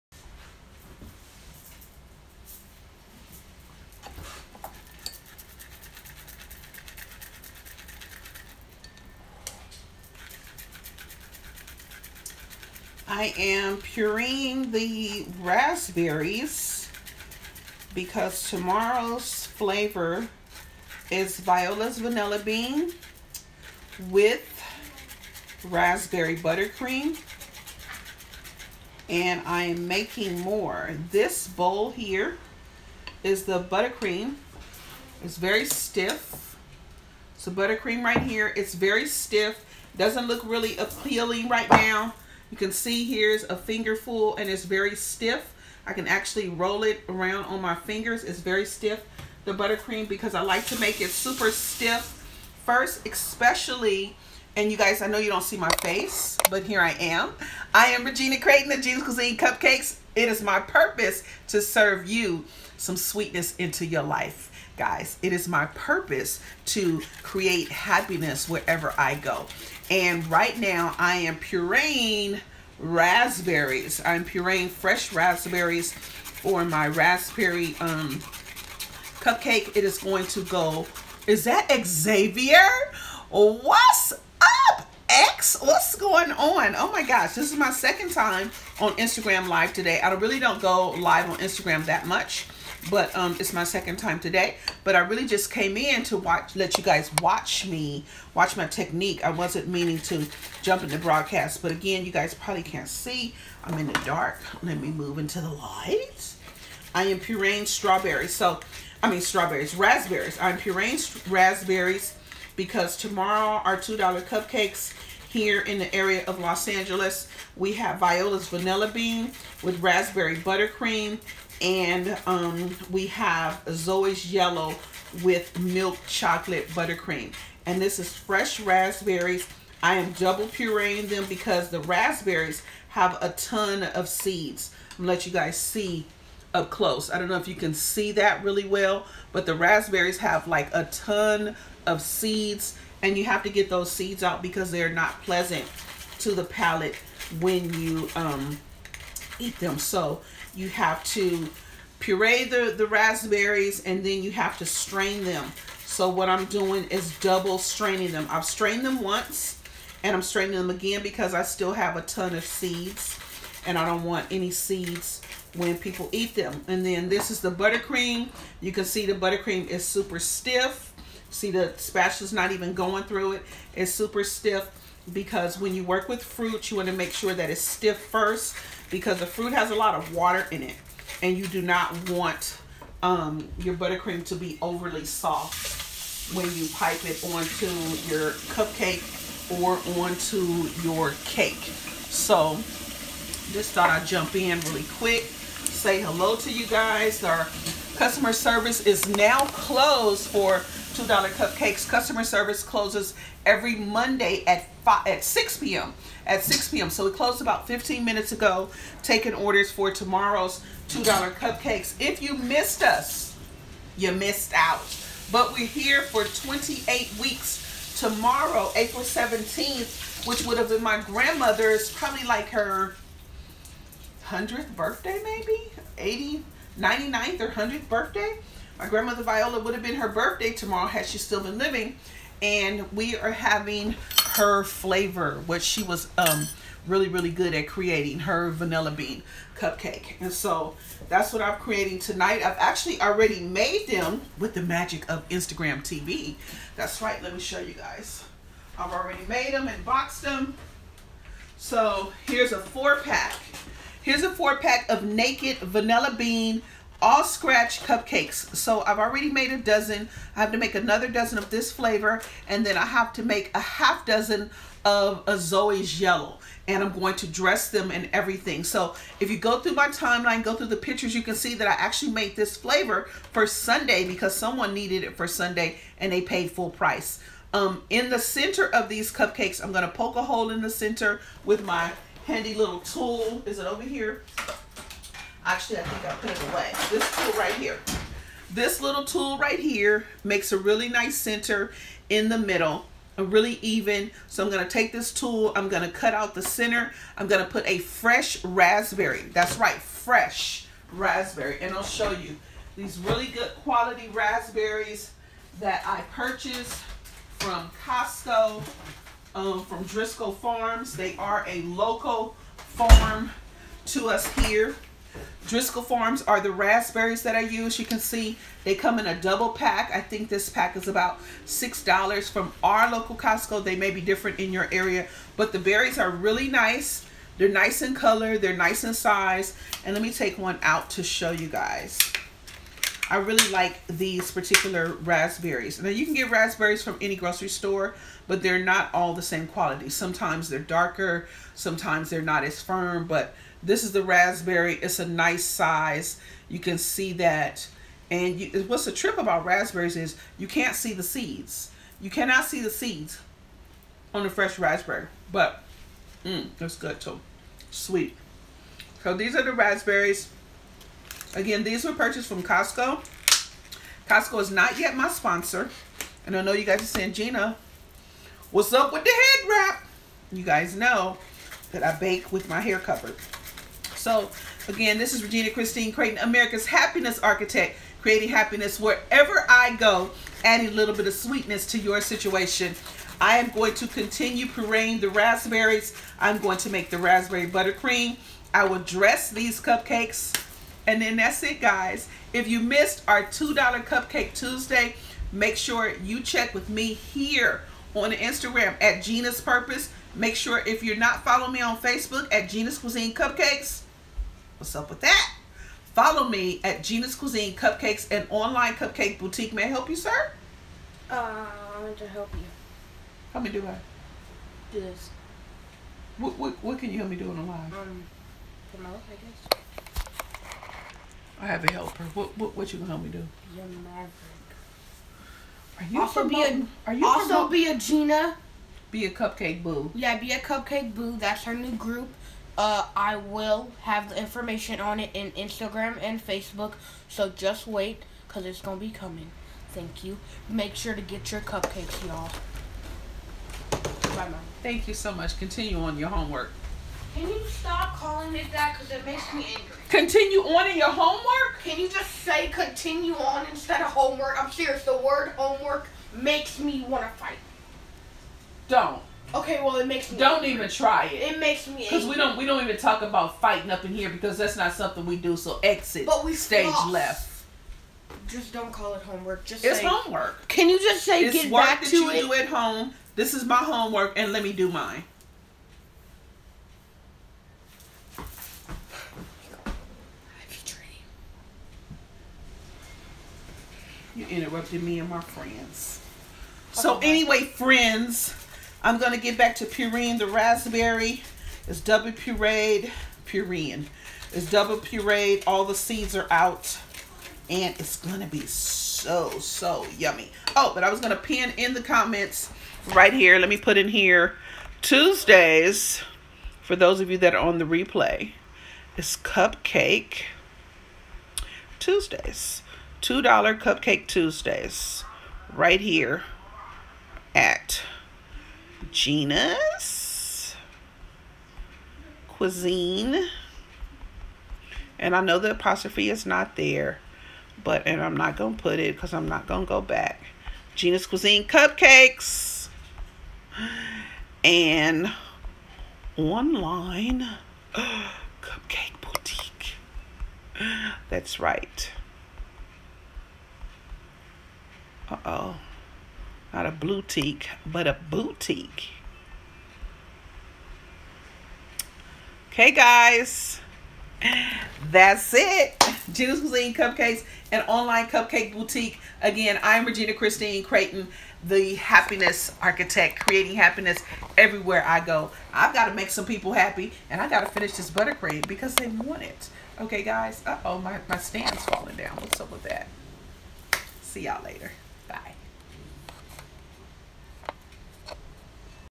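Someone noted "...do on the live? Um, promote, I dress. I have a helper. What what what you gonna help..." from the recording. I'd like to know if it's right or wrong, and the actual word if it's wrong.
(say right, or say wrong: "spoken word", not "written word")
wrong: "guess", not "dress".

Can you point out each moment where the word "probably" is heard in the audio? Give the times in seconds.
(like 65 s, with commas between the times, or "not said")
102 s, 221 s.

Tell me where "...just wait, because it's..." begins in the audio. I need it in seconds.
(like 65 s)
437 s.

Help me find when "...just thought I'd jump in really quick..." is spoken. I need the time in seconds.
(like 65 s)
193 s.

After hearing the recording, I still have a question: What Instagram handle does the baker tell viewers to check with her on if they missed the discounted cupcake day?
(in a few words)
Gina's Purpose.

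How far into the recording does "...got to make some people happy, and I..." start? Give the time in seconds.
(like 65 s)
565 s.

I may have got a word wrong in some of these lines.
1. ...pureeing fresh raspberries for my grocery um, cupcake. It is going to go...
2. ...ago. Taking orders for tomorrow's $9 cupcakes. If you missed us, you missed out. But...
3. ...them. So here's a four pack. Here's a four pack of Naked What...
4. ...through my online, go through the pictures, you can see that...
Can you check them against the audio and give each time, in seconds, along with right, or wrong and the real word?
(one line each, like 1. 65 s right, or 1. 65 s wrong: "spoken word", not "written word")
1. 74 s wrong: "raspberry", not "grocery"
2. 208 s wrong: "2", not "9"
3. 250 s wrong: "Vanilla", not "What"
4. 269 s wrong: "timeline", not "online".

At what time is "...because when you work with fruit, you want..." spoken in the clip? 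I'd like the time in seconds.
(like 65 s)
175 s.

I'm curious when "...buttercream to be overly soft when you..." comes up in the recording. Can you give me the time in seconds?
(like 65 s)
183 s.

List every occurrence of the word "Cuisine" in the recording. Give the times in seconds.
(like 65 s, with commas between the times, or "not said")
59 s, 402 s, 407 s, 522 s, 531 s, 556 s.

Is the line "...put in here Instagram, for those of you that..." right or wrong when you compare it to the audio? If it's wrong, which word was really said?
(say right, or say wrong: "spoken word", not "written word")
wrong: "Tuesdays", not "Instagram".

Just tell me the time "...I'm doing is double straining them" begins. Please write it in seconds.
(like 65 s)
156 s.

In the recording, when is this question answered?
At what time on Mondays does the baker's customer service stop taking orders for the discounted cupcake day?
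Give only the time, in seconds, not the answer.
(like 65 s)
205 s.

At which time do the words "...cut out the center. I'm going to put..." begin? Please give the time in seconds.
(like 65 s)
295 s.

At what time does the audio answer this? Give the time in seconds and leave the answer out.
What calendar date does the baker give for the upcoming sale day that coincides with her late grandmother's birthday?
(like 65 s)
218 s.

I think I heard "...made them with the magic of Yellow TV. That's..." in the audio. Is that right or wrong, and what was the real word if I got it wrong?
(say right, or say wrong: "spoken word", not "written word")
wrong: "Instagram", not "Yellow".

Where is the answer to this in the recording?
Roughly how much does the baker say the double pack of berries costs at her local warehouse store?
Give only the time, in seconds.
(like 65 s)
320 s.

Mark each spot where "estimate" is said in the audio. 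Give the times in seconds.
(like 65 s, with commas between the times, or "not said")
not said.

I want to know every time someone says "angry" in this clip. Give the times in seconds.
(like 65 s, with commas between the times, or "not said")
449 s, 460 s.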